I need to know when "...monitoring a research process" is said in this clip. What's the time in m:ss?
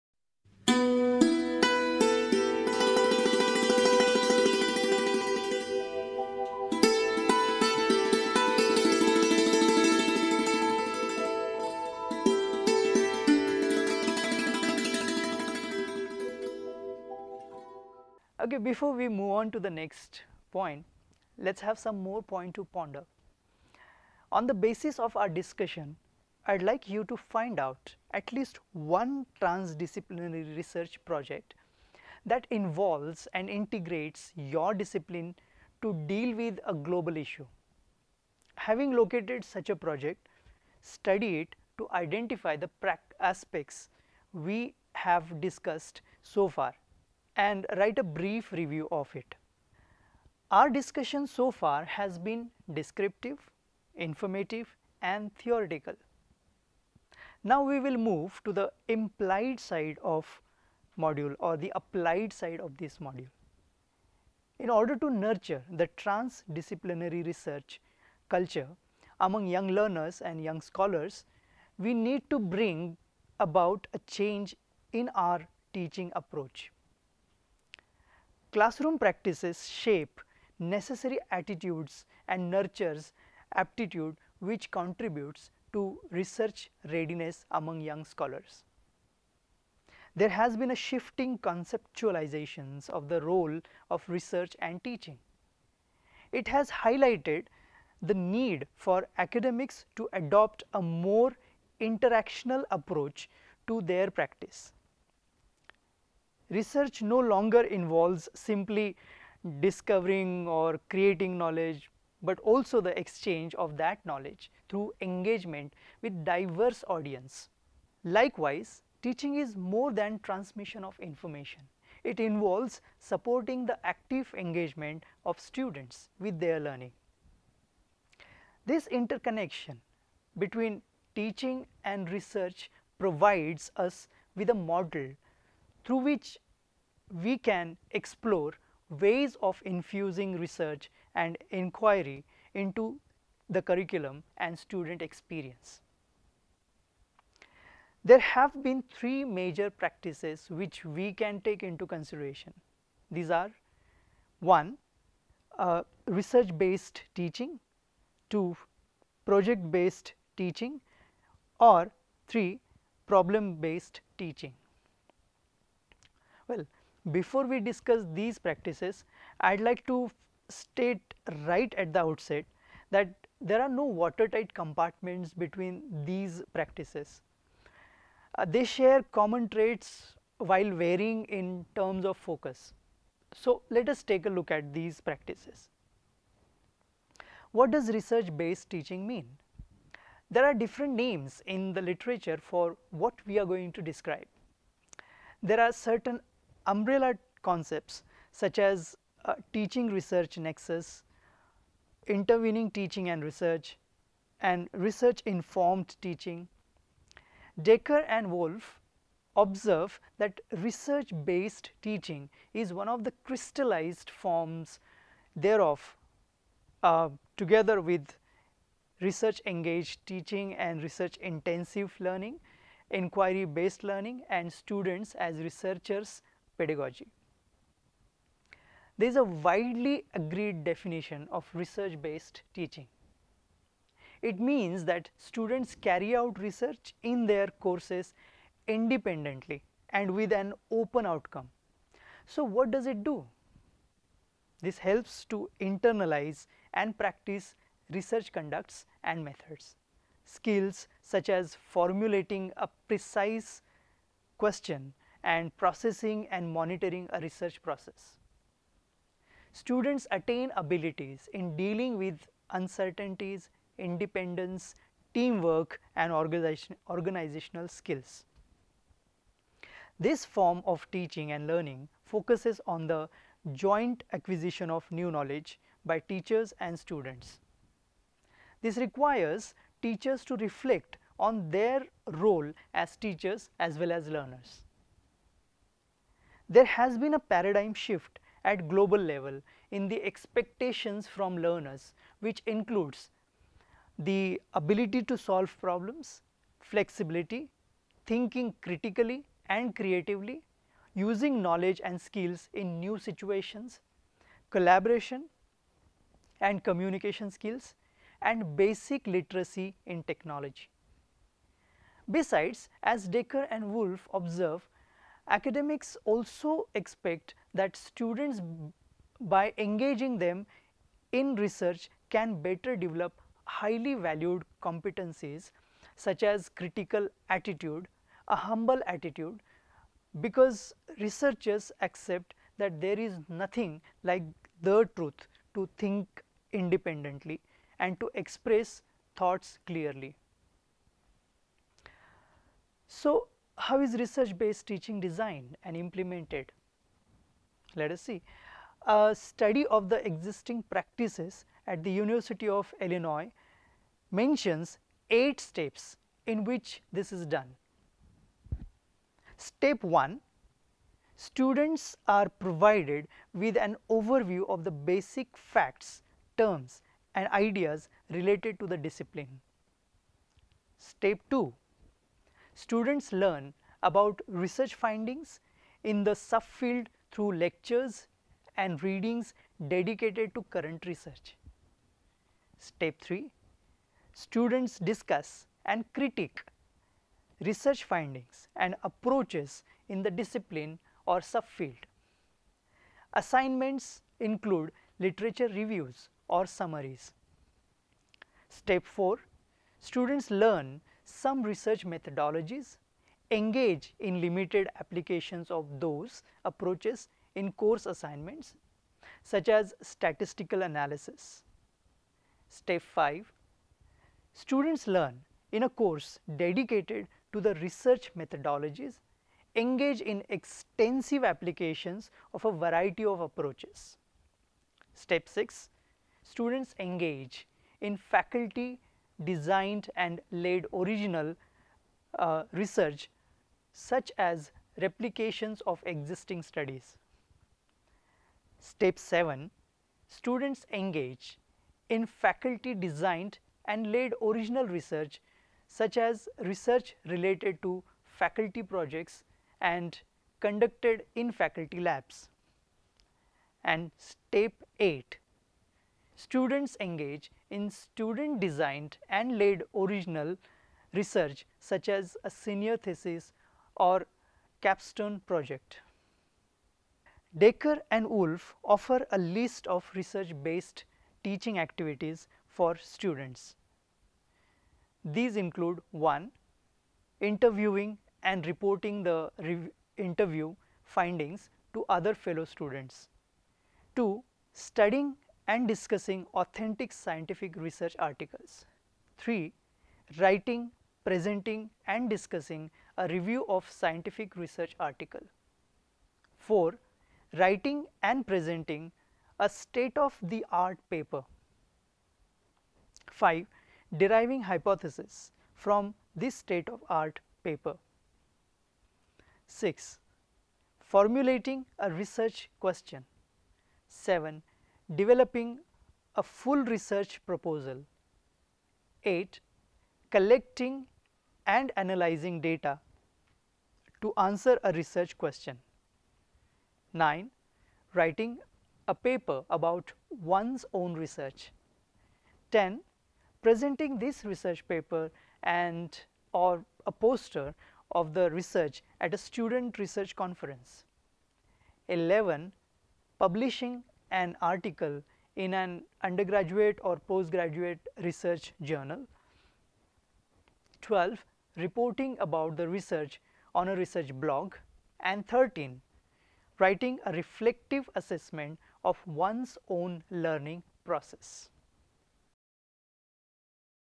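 4:16.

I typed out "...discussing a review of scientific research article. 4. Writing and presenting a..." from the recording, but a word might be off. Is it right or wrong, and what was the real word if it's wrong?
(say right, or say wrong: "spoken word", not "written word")
right.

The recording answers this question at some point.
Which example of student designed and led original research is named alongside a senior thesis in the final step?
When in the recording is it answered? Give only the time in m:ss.
7:44.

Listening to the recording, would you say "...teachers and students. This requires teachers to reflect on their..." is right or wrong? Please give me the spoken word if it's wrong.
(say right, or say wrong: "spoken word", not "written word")
right.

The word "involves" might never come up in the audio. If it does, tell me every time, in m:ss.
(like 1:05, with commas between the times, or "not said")
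0:32, 1:47, 2:02.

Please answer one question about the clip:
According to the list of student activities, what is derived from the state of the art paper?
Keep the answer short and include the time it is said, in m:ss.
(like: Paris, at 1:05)
Hypothesis, at 8:24.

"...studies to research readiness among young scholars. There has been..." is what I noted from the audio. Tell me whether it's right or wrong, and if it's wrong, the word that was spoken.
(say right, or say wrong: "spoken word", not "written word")
wrong: "contributes", not "studies".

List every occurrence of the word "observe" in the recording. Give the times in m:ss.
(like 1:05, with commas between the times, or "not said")
3:29, 5:14.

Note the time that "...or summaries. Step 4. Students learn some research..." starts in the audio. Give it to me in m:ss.
6:36.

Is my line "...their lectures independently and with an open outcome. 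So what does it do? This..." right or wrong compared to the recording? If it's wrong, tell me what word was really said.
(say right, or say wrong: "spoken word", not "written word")
wrong: "courses", not "lectures".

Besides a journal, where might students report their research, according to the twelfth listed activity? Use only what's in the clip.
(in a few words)
A research blog.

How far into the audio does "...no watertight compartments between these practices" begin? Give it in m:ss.
2:53.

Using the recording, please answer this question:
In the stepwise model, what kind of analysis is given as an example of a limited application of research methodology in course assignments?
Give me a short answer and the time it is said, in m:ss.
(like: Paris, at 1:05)
Statistical analysis, at 6:49.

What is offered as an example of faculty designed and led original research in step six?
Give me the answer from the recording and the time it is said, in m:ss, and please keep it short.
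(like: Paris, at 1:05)
Replications of existing studies, at 7:14.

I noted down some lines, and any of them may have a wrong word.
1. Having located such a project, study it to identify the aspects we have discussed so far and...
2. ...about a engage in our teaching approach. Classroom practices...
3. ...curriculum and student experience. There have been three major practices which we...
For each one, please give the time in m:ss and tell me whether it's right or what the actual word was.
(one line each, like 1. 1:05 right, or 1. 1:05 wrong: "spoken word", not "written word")
1. 0:38 right
2. 1:13 wrong: "change", not "engage"
3. 2:23 right.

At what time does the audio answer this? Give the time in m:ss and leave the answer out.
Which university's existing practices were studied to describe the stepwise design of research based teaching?
5:51.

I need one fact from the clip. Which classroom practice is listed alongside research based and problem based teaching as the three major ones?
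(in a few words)
Project based teaching.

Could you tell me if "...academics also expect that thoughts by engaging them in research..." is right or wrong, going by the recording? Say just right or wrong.
wrong.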